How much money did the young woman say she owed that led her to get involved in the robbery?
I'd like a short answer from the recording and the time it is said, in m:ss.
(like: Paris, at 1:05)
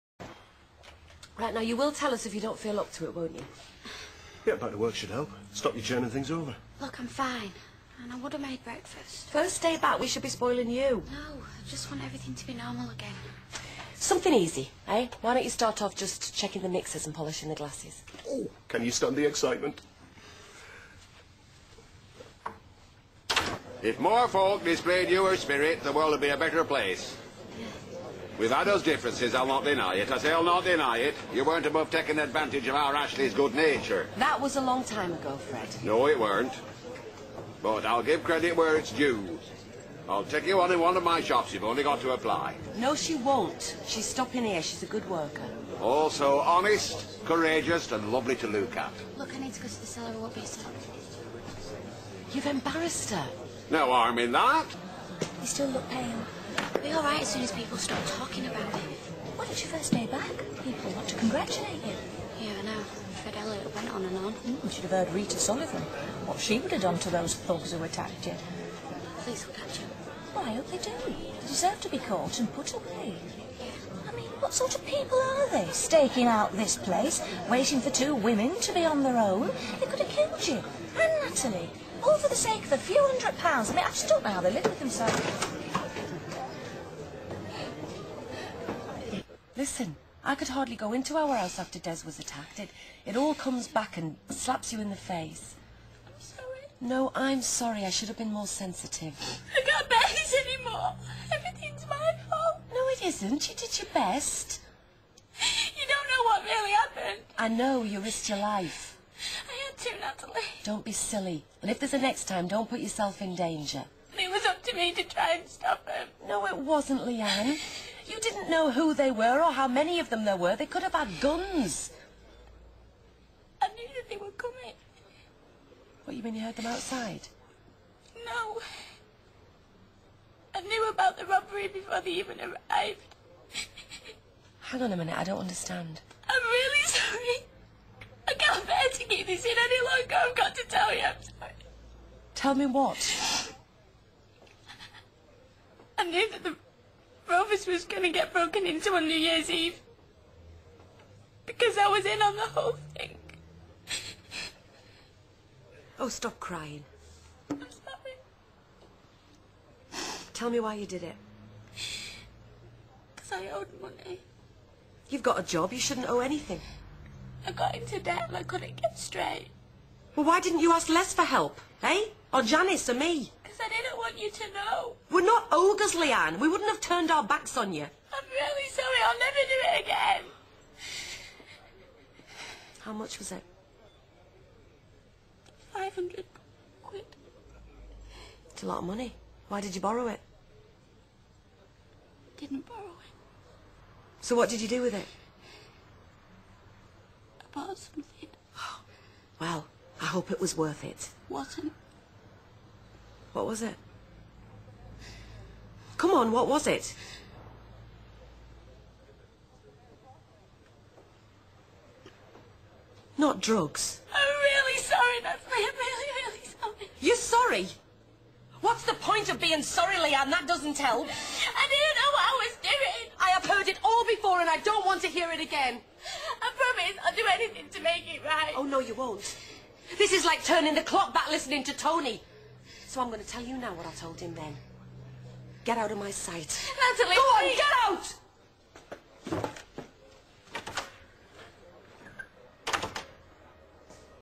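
500 quid, at 3:05.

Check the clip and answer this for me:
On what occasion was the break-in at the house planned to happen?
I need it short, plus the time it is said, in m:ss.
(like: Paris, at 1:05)
New Year's Eve, at 2:29.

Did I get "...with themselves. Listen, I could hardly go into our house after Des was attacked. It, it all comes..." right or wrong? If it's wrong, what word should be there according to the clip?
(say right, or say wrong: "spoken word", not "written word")
right.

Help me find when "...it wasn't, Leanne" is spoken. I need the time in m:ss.
1:56.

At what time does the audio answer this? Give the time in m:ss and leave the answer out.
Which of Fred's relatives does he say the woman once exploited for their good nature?
0:32.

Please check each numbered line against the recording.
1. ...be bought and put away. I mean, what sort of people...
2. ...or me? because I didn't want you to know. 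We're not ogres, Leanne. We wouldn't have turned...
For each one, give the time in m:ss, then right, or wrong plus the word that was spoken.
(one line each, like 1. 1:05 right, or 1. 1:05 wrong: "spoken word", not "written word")
1. 1:11 wrong: "caught", not "bought"
2. 2:52 right.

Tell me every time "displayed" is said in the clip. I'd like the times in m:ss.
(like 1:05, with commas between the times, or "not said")
0:24.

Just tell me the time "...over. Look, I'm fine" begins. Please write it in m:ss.
0:06.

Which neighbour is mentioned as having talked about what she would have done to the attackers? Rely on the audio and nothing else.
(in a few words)
Rita Sullivan.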